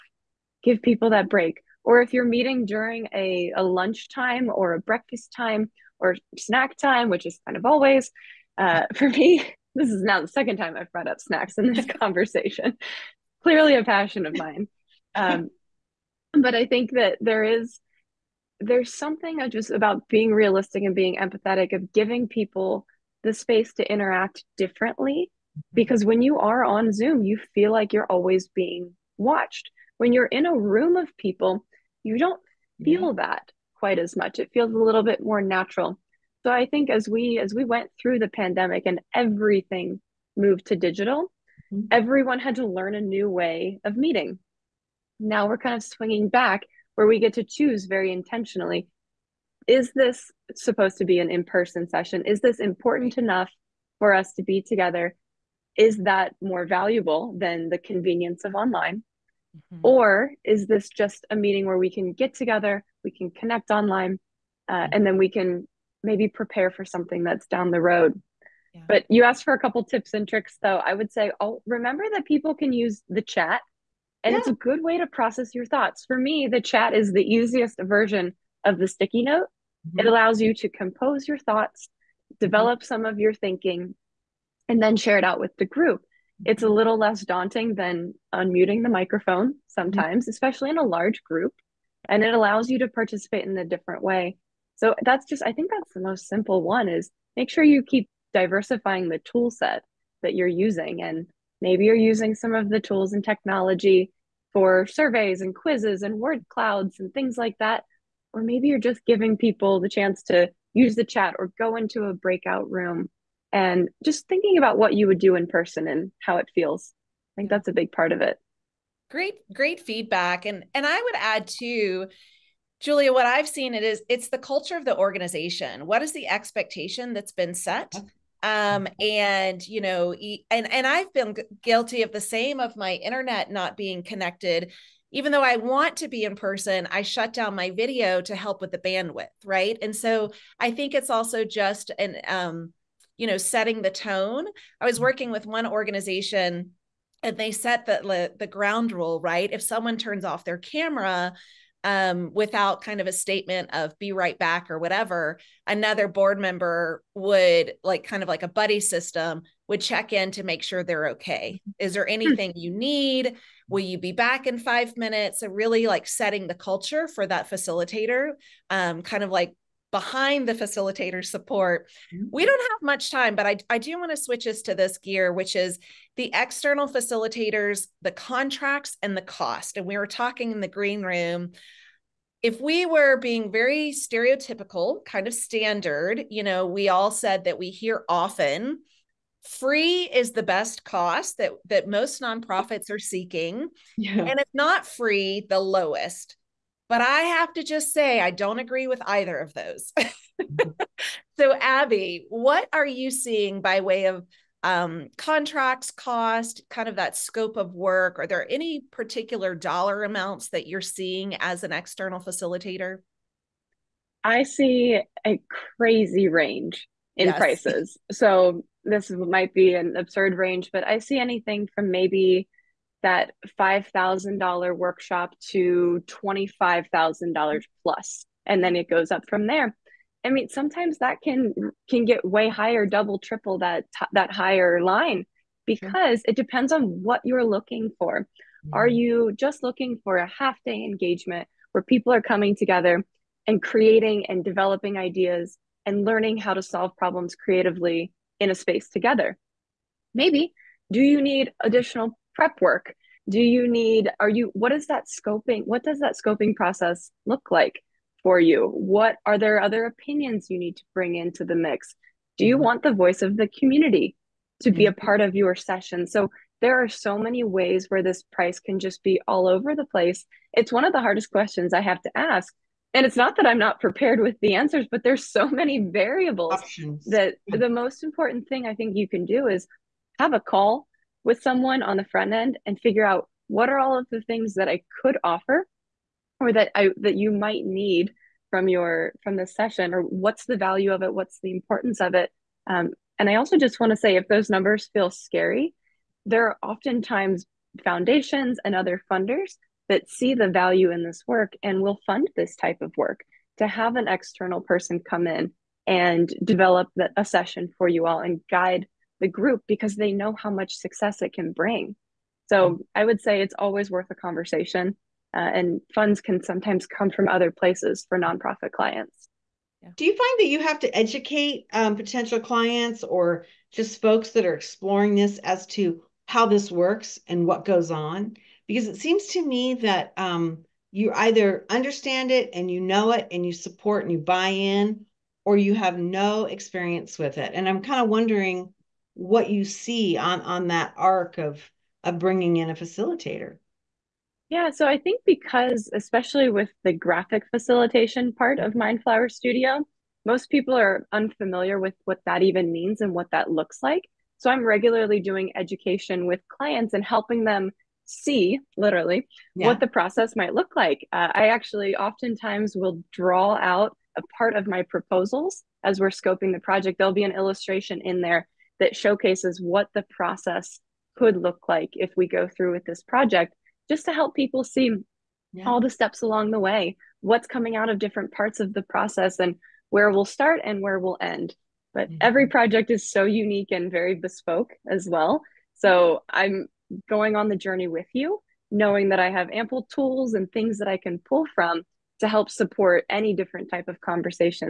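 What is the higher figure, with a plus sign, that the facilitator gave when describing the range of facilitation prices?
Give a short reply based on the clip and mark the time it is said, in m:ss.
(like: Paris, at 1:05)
$25,000, at 3:46.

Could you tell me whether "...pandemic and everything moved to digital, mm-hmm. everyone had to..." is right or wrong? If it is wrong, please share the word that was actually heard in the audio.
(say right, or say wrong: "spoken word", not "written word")
right.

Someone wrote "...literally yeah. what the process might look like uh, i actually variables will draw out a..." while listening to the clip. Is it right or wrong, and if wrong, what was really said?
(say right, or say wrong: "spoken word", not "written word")
wrong: "oftentimes", not "variables".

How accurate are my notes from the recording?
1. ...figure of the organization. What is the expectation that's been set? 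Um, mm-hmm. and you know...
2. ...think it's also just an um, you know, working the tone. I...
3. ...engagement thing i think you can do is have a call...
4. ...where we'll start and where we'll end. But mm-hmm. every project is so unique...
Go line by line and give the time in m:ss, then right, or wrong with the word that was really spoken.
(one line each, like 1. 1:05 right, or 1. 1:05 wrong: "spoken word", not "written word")
1. 2:04 wrong: "culture", not "figure"
2. 2:20 wrong: "setting", not "working"
3. 4:38 wrong: "important", not "engagement"
4. 6:19 right.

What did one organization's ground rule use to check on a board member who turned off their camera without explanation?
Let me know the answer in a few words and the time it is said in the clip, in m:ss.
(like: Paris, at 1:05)
A buddy system, at 2:38.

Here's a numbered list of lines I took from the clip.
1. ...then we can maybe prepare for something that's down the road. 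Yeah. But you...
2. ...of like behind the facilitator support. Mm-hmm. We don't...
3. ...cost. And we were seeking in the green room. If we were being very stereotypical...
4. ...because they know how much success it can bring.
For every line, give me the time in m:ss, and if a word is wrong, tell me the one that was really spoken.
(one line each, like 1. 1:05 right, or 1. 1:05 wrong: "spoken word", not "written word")
1. 1:05 right
2. 2:49 right
3. 2:59 wrong: "talking", not "seeking"
4. 5:09 right.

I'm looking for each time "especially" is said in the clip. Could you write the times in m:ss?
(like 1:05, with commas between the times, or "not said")
1:30, 5:45.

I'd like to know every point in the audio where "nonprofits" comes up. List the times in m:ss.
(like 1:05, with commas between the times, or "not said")
3:12, 5:18.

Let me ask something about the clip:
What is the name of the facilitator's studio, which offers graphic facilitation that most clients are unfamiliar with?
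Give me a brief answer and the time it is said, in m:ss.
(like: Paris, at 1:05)
Mindflower Studio, at 5:48.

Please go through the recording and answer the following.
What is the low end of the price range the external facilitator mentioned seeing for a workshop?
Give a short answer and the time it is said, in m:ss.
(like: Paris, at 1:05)
$5,000, at 3:43.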